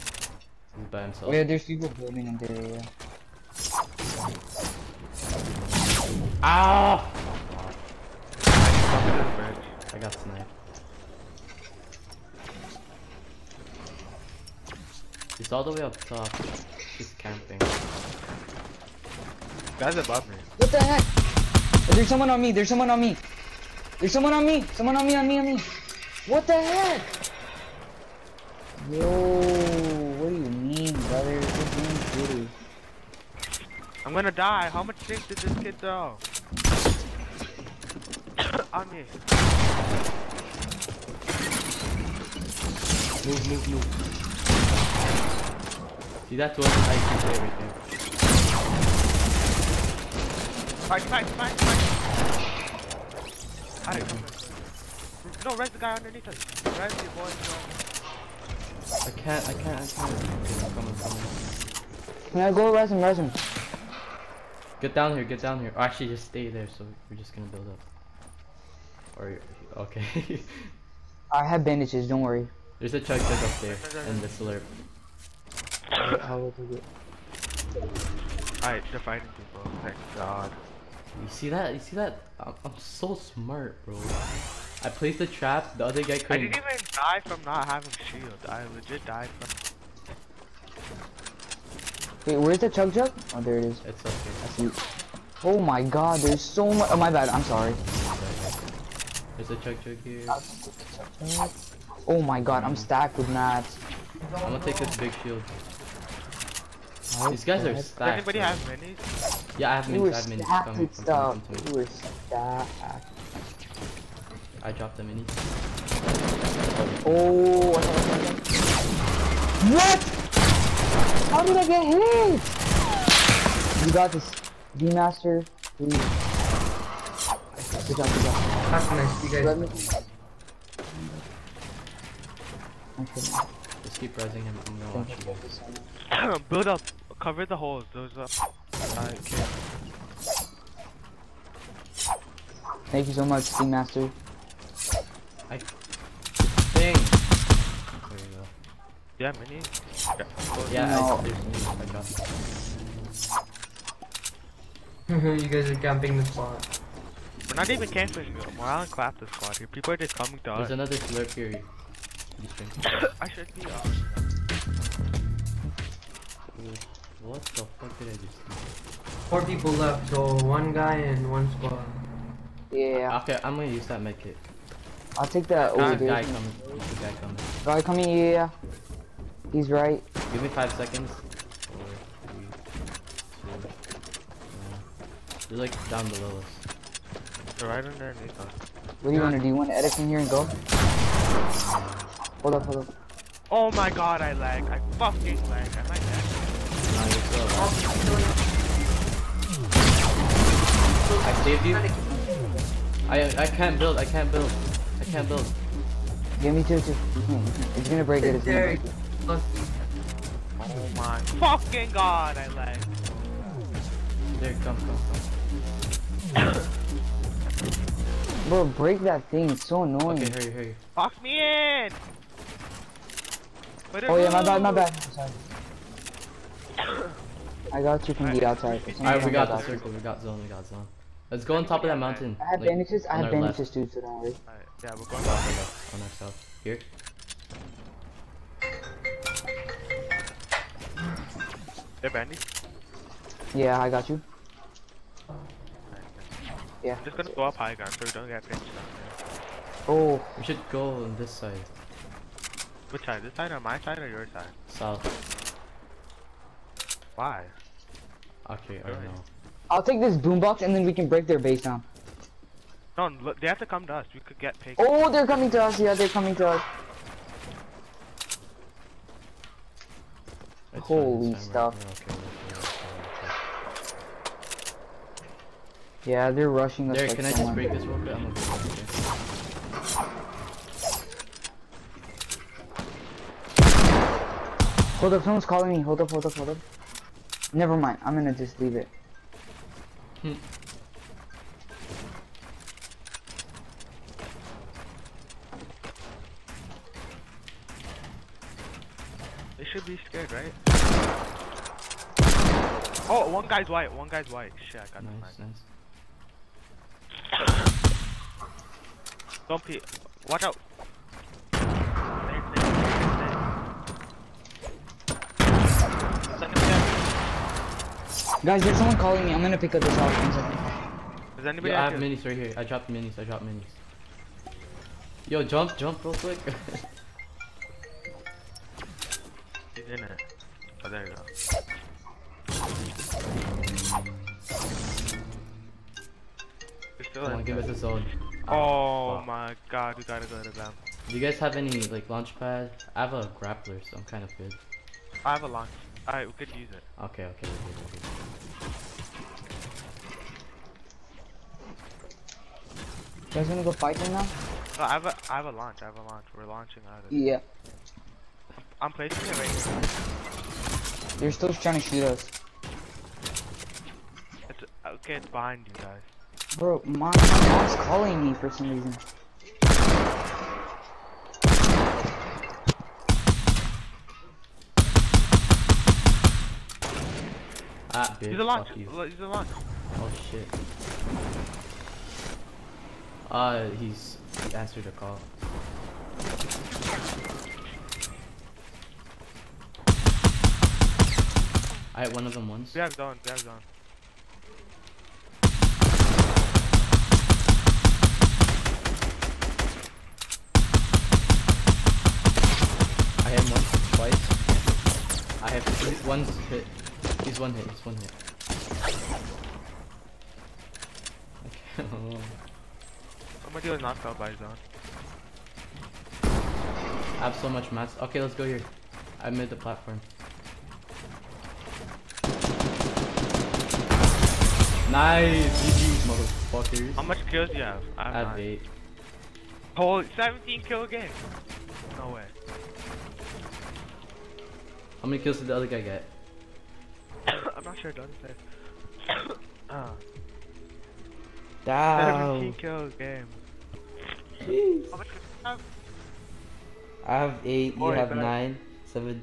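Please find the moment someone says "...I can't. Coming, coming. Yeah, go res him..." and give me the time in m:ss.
0:59.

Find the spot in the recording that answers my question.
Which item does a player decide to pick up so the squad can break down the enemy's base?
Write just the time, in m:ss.
4:19.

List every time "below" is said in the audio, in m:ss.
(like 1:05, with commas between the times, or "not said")
3:06.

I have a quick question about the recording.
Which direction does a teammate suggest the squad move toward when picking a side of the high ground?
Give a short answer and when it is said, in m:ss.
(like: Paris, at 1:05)
south, at 4:14.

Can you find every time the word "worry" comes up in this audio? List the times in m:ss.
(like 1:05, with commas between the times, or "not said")
1:12, 3:54.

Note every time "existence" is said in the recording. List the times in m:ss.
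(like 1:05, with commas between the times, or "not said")
not said.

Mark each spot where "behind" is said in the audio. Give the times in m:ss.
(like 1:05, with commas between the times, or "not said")
6:05.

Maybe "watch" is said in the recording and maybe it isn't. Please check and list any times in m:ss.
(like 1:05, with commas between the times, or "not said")
2:14, 5:10.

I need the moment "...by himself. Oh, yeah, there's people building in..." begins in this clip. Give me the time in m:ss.
0:00.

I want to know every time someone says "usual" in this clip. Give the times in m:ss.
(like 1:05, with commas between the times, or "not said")
not said.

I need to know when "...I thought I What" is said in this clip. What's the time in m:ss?
1:57.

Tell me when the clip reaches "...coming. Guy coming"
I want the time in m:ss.
2:57.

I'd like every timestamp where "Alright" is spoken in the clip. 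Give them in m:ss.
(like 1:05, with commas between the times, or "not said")
0:50, 1:18, 3:48, 5:46.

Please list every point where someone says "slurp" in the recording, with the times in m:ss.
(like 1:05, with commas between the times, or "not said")
1:14, 2:40.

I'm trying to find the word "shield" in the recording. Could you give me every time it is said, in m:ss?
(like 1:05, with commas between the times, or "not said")
1:28, 1:45.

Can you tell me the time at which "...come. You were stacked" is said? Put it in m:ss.
1:51.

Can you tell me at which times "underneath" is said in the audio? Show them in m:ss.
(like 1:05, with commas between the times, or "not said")
0:55, 3:07.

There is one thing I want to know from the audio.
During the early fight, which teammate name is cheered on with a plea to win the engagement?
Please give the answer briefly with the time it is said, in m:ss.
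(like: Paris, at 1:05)
V Master, at 2:04.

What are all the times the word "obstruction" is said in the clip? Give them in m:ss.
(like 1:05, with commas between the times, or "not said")
not said.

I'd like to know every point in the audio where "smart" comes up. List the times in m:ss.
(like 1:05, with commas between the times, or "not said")
1:23.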